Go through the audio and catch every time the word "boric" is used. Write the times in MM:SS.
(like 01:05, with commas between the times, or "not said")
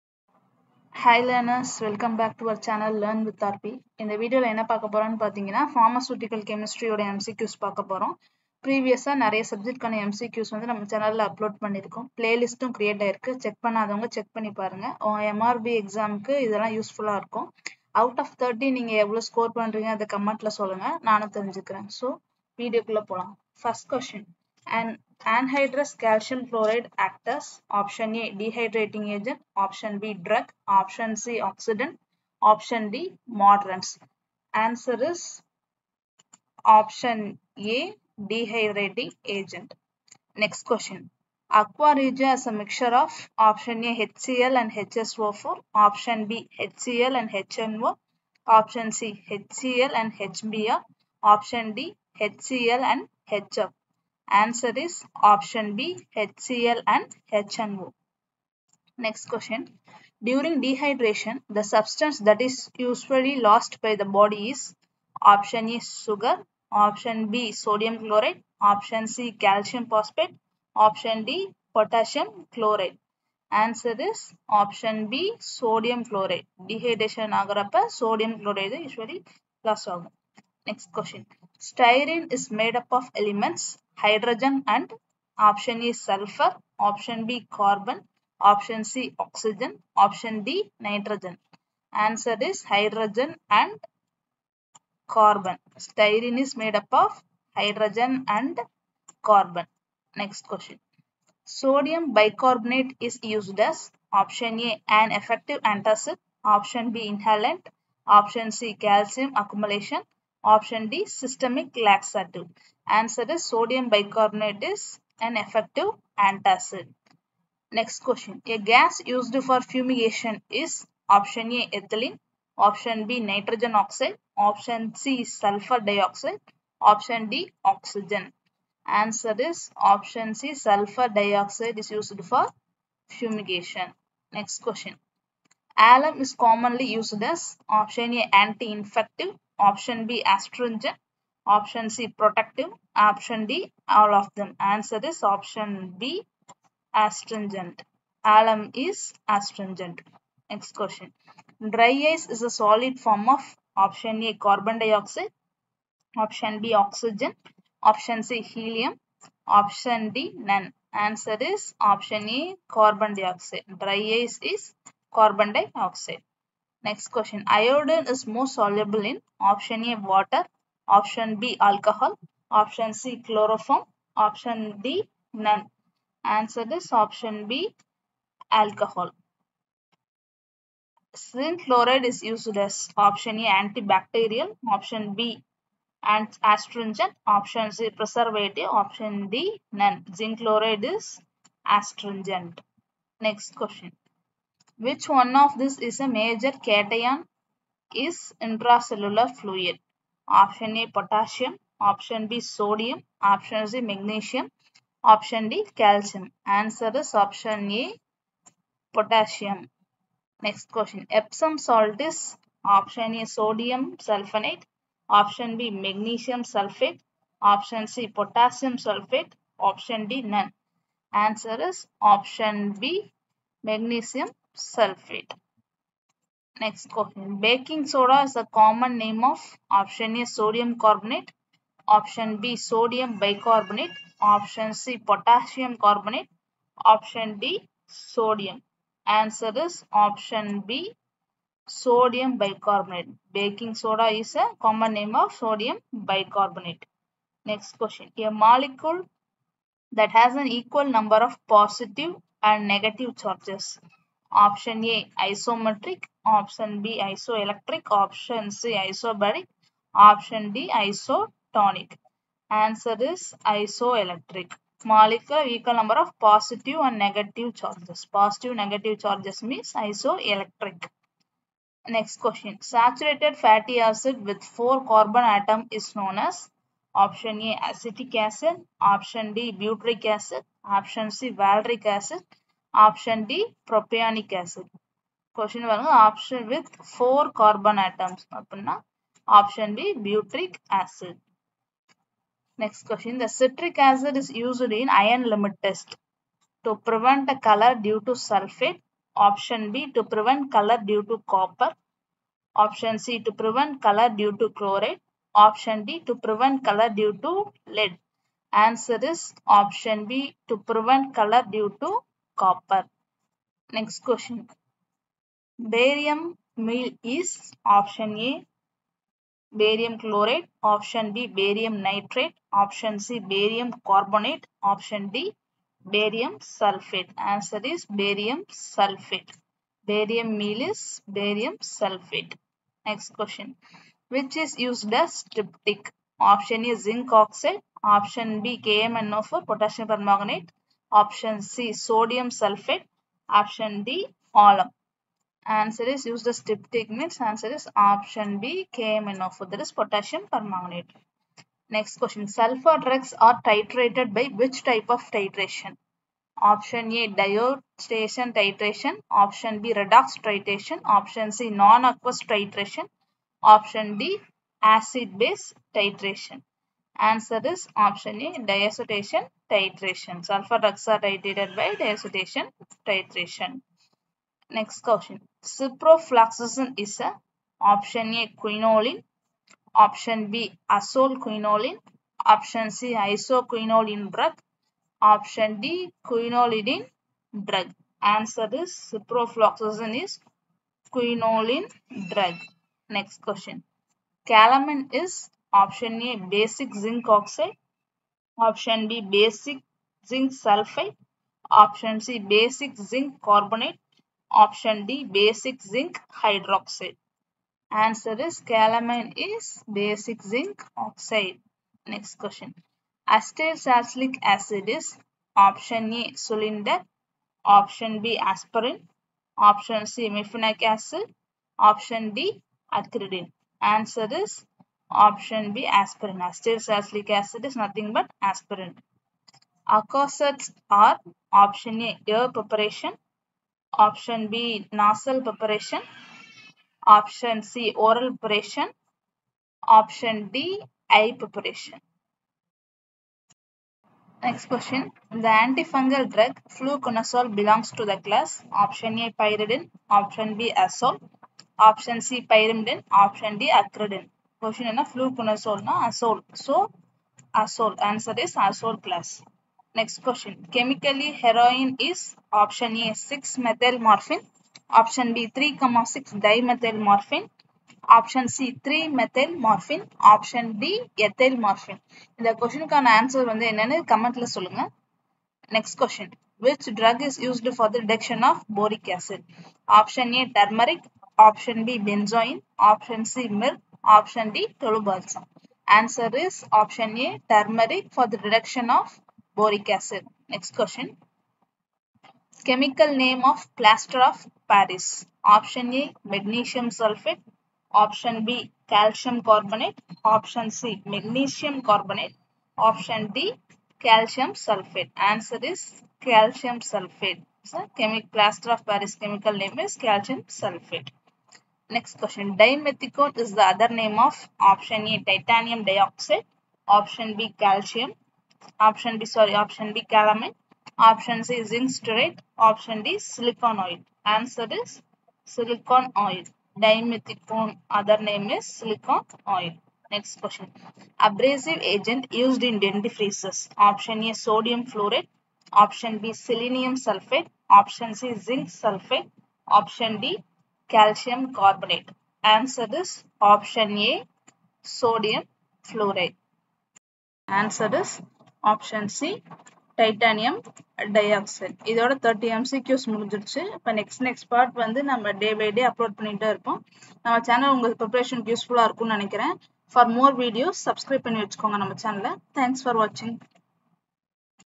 07:58, 08:09.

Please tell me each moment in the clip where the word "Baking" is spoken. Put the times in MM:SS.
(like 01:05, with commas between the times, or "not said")
03:47, 04:03.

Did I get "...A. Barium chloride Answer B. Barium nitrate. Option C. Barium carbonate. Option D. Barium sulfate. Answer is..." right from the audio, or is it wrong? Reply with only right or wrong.
wrong.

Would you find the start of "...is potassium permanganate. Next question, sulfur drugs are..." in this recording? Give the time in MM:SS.
05:49.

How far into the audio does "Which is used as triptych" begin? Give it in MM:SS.
05:34.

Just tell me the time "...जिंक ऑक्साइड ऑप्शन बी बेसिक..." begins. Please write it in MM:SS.
06:36.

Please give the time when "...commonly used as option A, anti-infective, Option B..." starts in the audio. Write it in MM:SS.
02:16.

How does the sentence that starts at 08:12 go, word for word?
Chemical name of plaster of Paris.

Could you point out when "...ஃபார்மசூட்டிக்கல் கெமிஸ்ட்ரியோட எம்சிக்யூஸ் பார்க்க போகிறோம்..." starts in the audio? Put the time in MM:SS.
00:05.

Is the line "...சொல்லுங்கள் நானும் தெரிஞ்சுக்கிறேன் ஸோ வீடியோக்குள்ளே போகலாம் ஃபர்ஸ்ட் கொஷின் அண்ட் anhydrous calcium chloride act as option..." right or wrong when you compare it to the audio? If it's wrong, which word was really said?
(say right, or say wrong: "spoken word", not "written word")
right.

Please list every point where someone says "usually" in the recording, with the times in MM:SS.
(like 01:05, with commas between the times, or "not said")
01:02, 01:18.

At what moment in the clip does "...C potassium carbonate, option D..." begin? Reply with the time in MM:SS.
03:54.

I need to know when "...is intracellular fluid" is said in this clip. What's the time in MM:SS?
03:18.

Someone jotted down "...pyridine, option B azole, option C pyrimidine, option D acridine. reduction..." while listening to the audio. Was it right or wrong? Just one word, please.
wrong.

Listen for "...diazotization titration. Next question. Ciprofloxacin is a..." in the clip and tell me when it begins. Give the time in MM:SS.
06:11.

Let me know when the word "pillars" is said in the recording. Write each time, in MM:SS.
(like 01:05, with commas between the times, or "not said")
not said.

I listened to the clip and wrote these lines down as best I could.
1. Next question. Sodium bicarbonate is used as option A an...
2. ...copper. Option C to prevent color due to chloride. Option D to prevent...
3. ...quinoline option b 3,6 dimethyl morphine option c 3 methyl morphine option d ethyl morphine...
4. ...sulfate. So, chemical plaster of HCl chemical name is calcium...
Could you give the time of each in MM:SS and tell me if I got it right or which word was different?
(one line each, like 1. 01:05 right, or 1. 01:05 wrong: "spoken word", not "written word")
1. 01:40 right
2. 05:01 right
3. 07:43 wrong: "morphine", not "quinoline"
4. 08:26 wrong: "Paris", not "HCl".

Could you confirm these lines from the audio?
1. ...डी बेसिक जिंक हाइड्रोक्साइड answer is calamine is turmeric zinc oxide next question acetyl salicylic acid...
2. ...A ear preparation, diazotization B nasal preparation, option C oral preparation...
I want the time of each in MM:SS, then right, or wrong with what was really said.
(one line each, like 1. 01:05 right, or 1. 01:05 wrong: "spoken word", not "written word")
1. 06:44 wrong: "basic", not "turmeric"
2. 07:11 wrong: "option", not "diazotization".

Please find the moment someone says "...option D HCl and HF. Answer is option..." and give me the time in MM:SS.
00:51.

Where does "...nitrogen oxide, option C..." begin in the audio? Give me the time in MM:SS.
02:03.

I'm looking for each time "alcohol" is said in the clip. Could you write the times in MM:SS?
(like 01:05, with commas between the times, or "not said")
02:51, 02:58.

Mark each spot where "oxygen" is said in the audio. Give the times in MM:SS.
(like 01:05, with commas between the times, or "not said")
01:29, 02:07, 02:36.